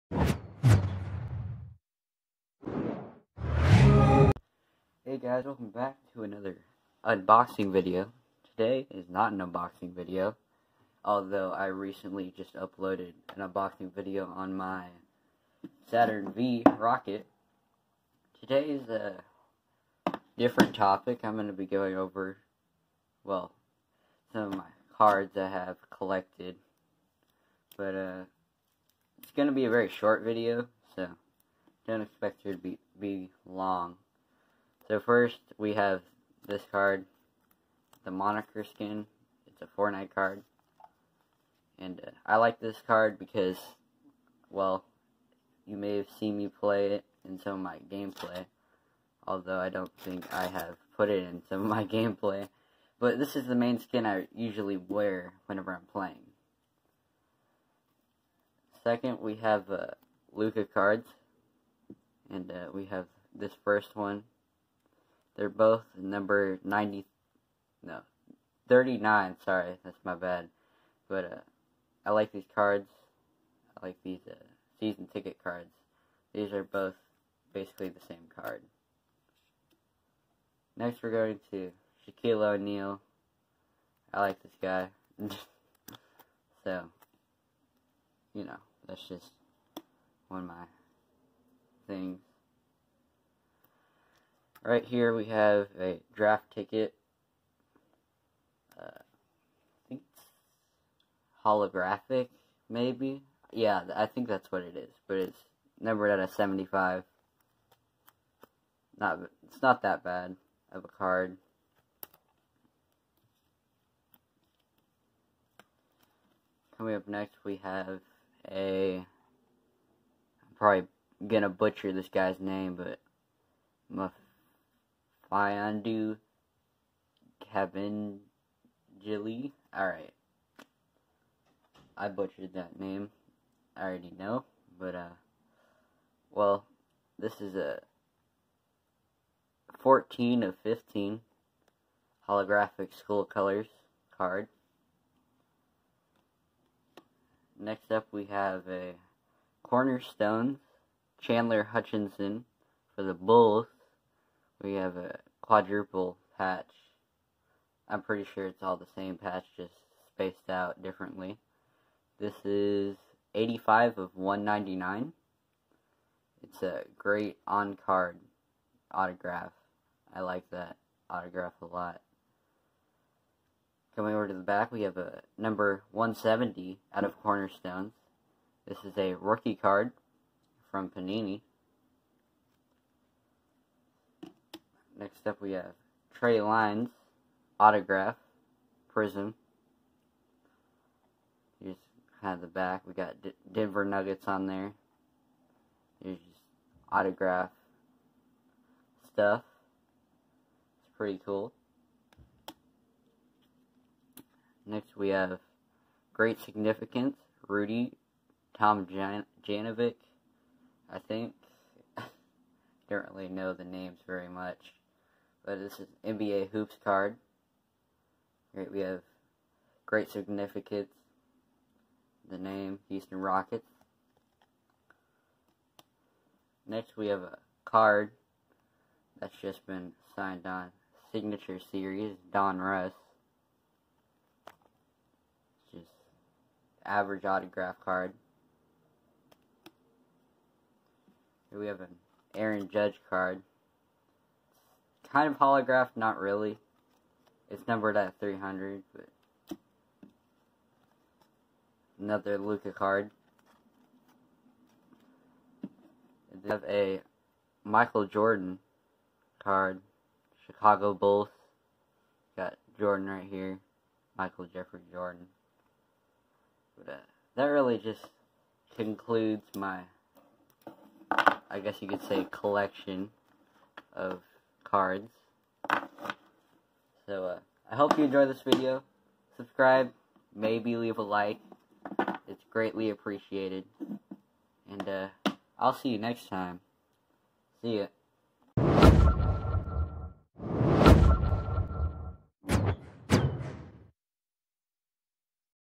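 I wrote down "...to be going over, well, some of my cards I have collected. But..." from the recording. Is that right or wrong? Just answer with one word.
right.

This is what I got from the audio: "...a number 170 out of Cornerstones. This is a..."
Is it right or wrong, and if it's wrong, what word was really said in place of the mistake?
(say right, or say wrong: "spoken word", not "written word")
right.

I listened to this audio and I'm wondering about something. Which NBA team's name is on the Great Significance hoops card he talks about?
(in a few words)
Houston Rockets.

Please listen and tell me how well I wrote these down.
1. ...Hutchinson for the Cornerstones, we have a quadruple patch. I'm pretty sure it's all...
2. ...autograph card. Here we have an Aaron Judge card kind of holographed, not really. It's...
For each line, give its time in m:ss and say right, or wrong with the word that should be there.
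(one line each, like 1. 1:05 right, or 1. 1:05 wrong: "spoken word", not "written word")
1. 2:31 wrong: "Bulls", not "Cornerstones"
2. 3:57 right.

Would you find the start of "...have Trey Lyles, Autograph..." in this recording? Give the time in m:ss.
3:05.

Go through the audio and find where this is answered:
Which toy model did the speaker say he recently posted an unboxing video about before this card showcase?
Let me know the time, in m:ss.
0:15.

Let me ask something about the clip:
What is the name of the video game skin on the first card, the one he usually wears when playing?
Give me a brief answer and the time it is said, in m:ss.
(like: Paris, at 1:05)
Moniker, at 0:38.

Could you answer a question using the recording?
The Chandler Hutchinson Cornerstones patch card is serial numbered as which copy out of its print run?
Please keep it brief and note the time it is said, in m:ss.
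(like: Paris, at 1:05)
85 of 199, at 2:43.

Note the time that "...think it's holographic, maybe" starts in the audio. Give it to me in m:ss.
1:39.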